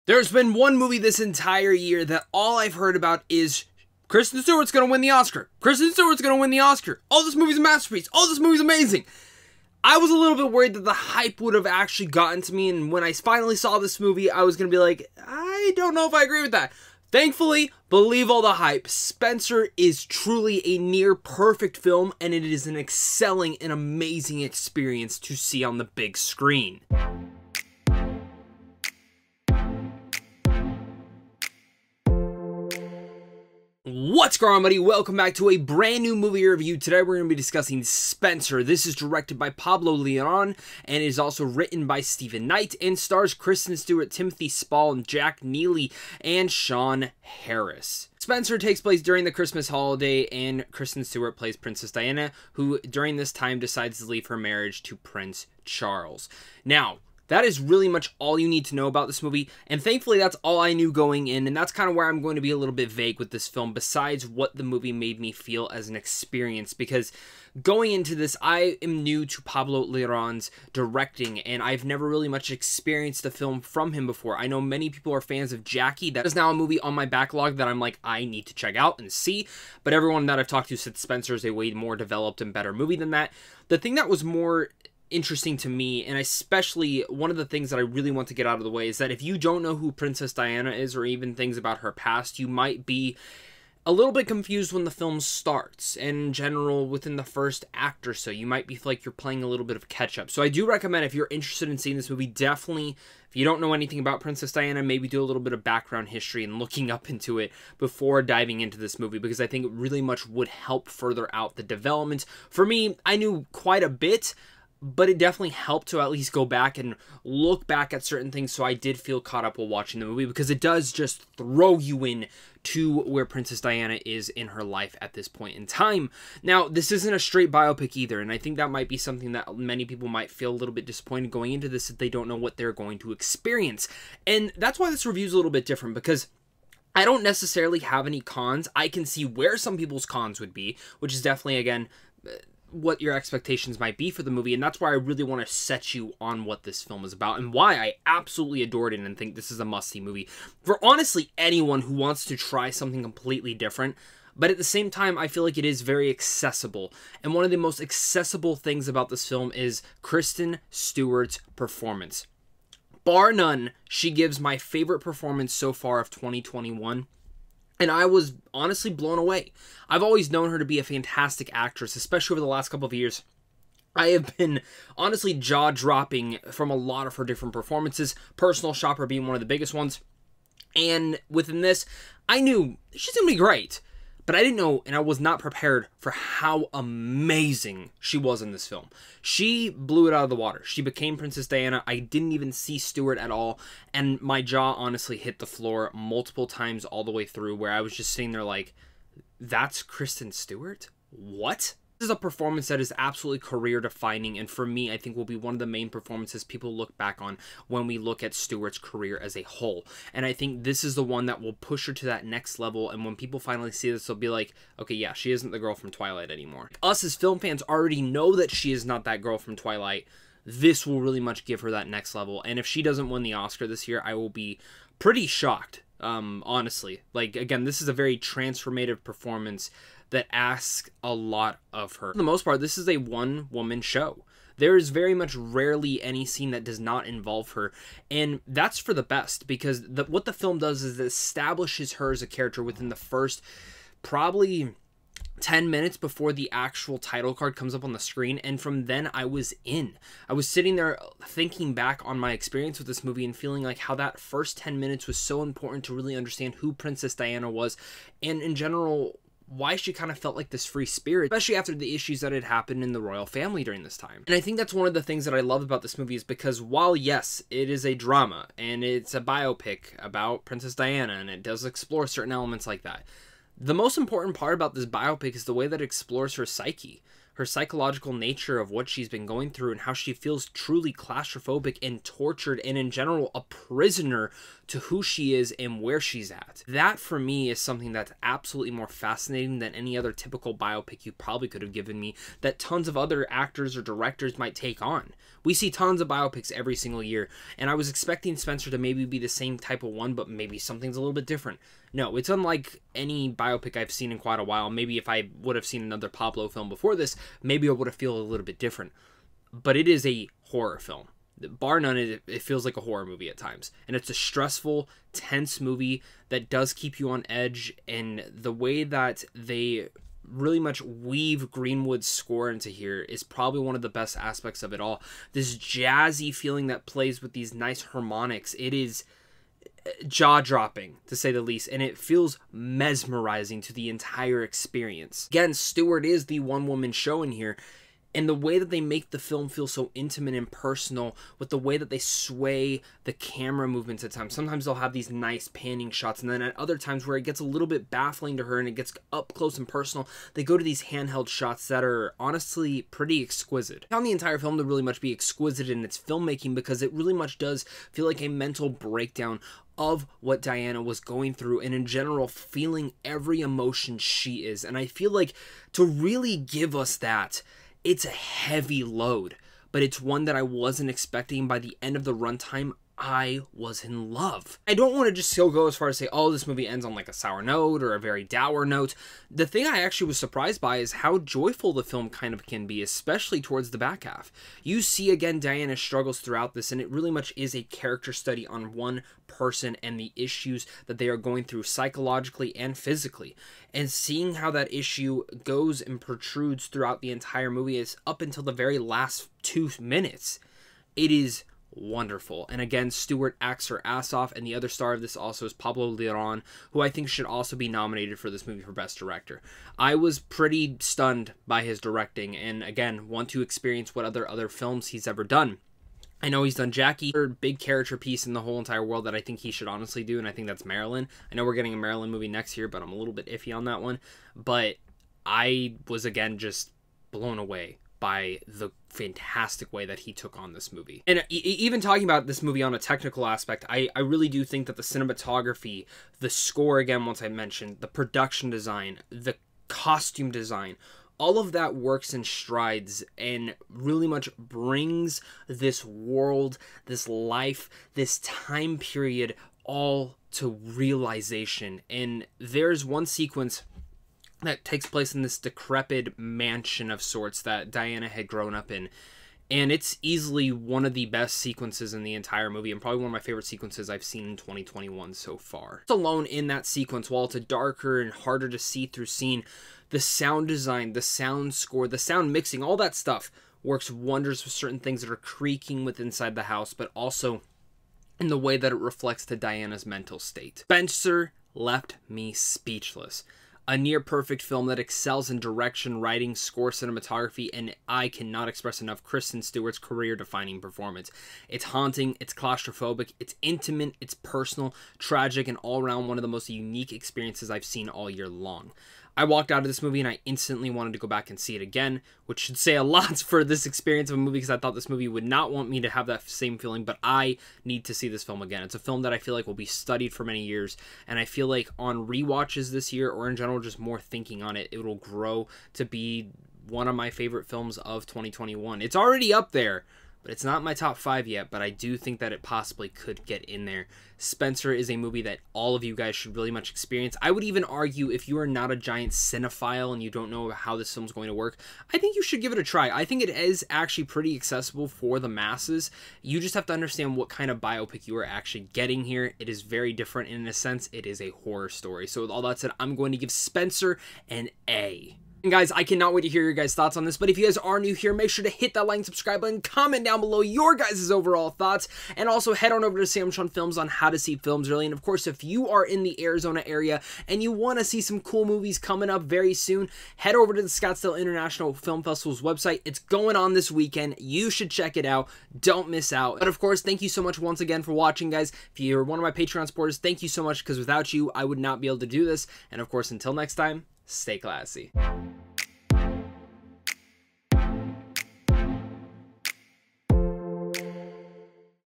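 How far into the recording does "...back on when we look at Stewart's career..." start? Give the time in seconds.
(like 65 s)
206 s.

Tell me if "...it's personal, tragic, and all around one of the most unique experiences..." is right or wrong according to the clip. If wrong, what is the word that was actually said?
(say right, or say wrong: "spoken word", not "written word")
right.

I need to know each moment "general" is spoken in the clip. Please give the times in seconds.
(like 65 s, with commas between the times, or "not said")
96 s, 258 s, 282 s, 361 s, 513 s.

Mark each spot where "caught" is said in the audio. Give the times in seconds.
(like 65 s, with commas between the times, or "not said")
119 s.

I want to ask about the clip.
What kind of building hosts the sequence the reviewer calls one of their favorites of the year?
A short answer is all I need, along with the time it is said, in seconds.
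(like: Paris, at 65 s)
Decrepit mansion, at 455 s.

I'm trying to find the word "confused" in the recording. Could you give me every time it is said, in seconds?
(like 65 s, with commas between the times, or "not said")
94 s.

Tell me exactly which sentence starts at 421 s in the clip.
I know we're getting a Marilyn movie next year, but I'm a little bit iffy on that one.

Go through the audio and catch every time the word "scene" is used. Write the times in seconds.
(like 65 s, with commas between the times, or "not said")
236 s, 469 s.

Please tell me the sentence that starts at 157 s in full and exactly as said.
And one of the most accessible things about this film is Kristen Stewart's performance.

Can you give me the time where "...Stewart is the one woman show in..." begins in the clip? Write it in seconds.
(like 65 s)
335 s.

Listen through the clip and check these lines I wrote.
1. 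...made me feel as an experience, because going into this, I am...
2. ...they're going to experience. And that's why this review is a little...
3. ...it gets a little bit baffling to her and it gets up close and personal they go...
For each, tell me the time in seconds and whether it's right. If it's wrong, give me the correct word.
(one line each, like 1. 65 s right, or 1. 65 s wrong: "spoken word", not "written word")
1. 64 s right
2. 132 s right
3. 347 s right.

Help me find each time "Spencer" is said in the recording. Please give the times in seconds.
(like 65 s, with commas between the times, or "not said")
18 s, 37 s, 48 s, 80 s, 298 s, 480 s, 524 s, 543 s.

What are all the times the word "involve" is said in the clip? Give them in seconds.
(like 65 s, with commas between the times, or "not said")
237 s.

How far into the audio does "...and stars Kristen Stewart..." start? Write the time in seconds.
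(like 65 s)
42 s.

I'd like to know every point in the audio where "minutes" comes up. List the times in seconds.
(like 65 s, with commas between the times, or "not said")
245 s, 254 s, 399 s.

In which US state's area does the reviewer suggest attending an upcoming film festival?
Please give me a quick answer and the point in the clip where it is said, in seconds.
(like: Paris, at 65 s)
Arizona, at 556 s.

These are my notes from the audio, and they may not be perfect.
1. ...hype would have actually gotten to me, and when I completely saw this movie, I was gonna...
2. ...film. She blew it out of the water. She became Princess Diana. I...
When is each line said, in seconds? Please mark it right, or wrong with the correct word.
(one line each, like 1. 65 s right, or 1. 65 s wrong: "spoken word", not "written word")
1. 10 s wrong: "finally", not "completely"
2. 188 s right.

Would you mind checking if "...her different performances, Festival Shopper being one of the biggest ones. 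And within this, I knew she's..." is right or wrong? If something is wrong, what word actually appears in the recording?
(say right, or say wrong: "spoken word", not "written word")
wrong: "Personal", not "Festival".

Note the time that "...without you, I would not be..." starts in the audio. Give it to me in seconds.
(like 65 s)
570 s.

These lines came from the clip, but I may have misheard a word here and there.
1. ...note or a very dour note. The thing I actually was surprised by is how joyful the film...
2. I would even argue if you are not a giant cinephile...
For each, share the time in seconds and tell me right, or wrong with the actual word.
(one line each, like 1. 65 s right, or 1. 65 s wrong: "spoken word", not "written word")
1. 377 s right
2. 527 s right.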